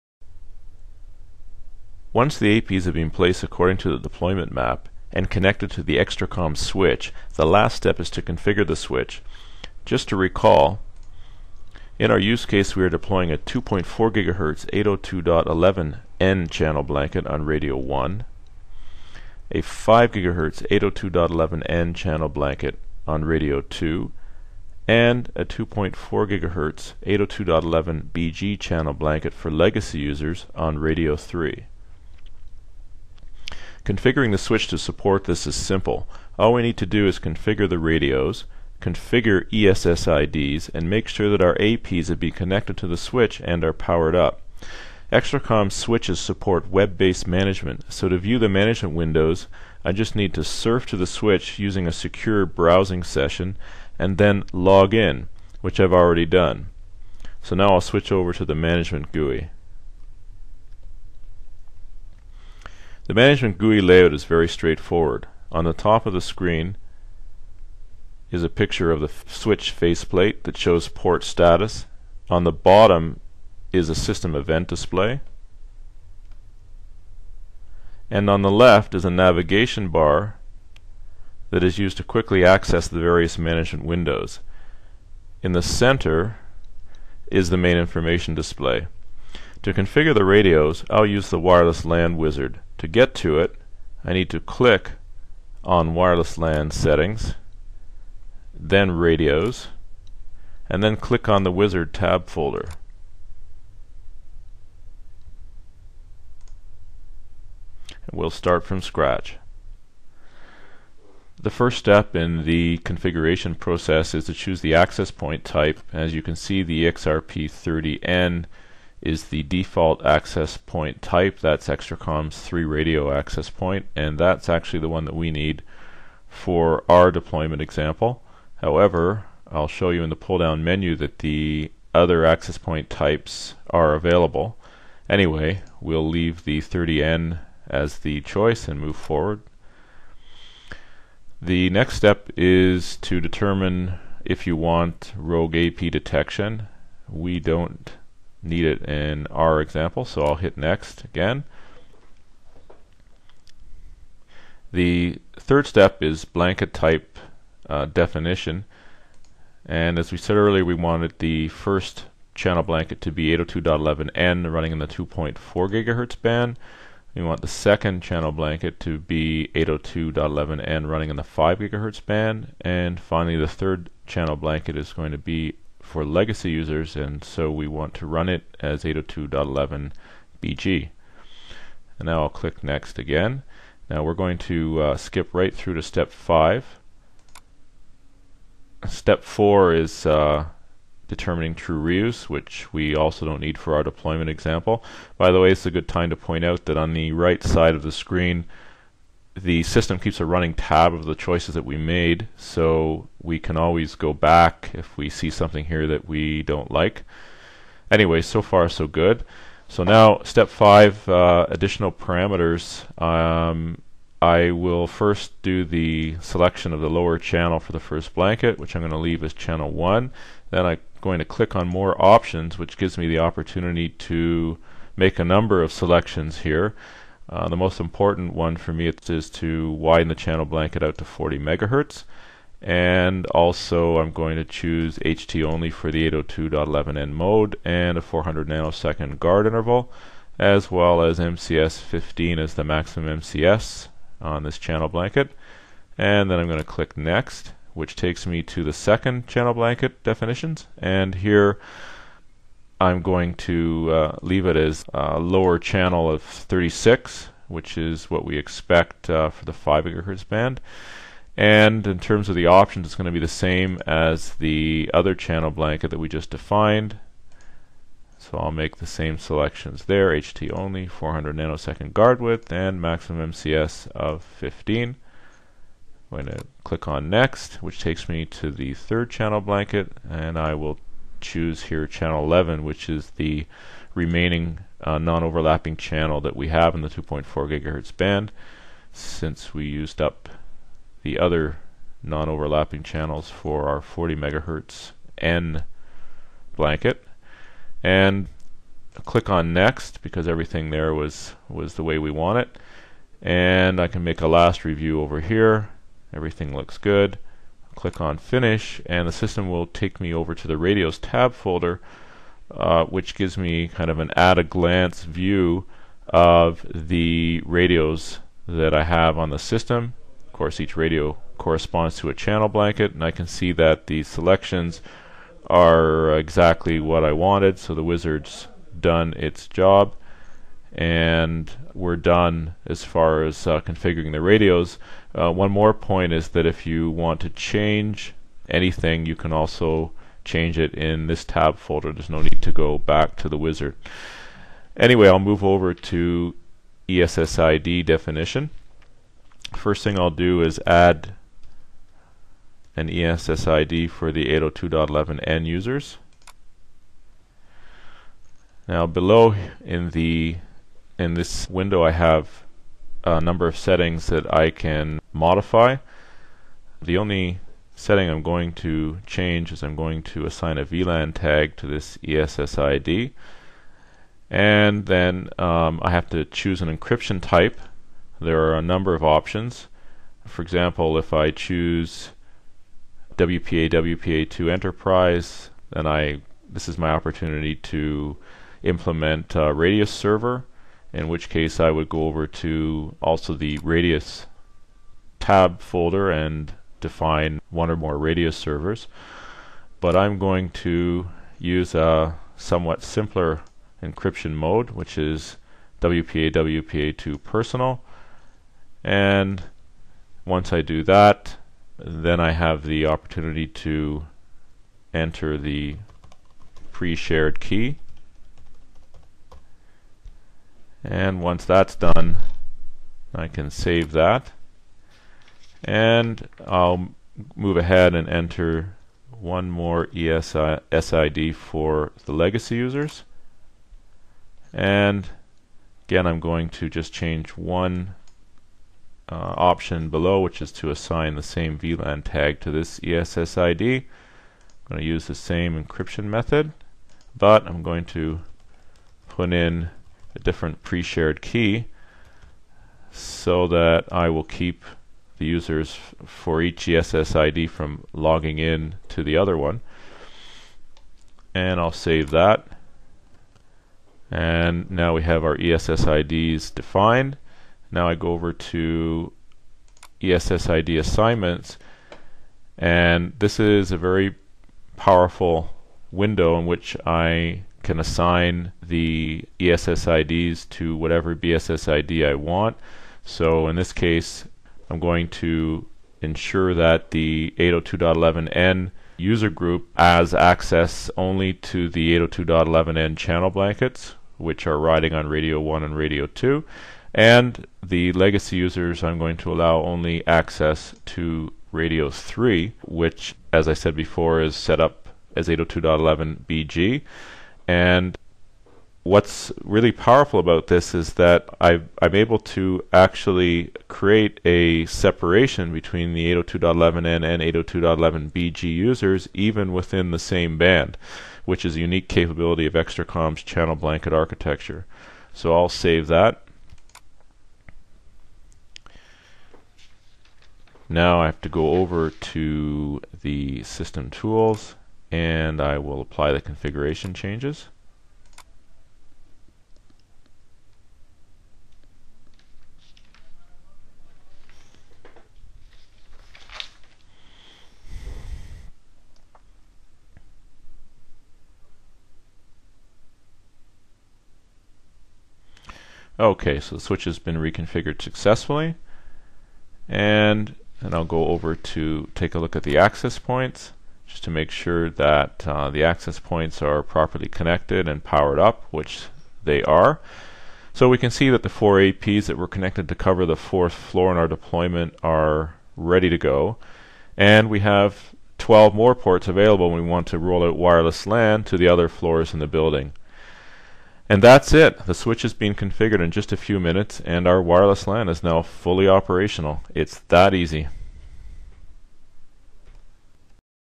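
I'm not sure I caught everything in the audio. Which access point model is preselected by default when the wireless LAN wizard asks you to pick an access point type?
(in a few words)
XRP30N.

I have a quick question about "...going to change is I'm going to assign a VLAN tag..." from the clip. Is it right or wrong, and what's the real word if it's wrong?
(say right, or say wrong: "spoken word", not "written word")
right.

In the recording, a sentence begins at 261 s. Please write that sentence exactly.
And in terms of the options, it's going to be the same as the other channel blanket that we just defined.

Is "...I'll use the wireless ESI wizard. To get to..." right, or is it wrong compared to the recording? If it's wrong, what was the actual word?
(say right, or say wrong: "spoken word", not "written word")
wrong: "LAN", not "ESI".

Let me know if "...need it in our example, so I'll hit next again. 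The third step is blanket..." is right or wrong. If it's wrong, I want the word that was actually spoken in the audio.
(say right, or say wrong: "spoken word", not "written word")
right.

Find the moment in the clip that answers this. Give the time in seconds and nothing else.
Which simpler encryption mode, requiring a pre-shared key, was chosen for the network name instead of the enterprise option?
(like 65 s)
405 s.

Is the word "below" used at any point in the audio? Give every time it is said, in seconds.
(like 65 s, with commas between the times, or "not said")
358 s, 439 s.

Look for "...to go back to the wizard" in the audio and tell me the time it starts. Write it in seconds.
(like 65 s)
342 s.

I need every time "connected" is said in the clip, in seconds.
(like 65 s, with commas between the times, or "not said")
5 s, 42 s, 567 s, 572 s.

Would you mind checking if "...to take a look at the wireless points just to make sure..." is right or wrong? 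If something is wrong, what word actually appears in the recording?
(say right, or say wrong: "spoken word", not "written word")
wrong: "access", not "wireless".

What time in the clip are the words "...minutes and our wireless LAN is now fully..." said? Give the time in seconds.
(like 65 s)
586 s.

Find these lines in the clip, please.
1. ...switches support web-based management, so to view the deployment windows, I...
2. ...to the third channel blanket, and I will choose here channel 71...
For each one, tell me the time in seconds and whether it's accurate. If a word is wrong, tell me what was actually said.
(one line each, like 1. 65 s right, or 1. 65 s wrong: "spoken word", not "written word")
1. 45 s wrong: "management", not "deployment"
2. 278 s wrong: "11", not "71".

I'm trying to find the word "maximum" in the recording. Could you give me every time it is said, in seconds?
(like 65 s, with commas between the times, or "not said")
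242 s, 272 s.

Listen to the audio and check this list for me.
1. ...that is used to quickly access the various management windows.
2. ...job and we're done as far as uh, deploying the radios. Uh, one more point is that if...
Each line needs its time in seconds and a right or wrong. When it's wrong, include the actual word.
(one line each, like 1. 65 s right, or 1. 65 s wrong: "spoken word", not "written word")
1. 81 s right
2. 329 s wrong: "configuring", not "deploying".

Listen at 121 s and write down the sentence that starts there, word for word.
That's Extricom's 3 radio access point, and that's actually the one that we need for our deployment example.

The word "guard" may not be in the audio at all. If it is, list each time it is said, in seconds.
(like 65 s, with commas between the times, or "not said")
239 s, 271 s.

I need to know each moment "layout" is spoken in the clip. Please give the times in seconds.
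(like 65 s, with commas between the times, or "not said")
63 s.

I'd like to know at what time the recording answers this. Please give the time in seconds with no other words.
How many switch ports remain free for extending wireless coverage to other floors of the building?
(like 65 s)
578 s.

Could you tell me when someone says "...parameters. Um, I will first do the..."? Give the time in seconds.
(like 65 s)
211 s.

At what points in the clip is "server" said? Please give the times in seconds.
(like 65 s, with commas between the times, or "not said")
389 s, 398 s.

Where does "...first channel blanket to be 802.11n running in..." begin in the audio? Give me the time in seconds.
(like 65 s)
161 s.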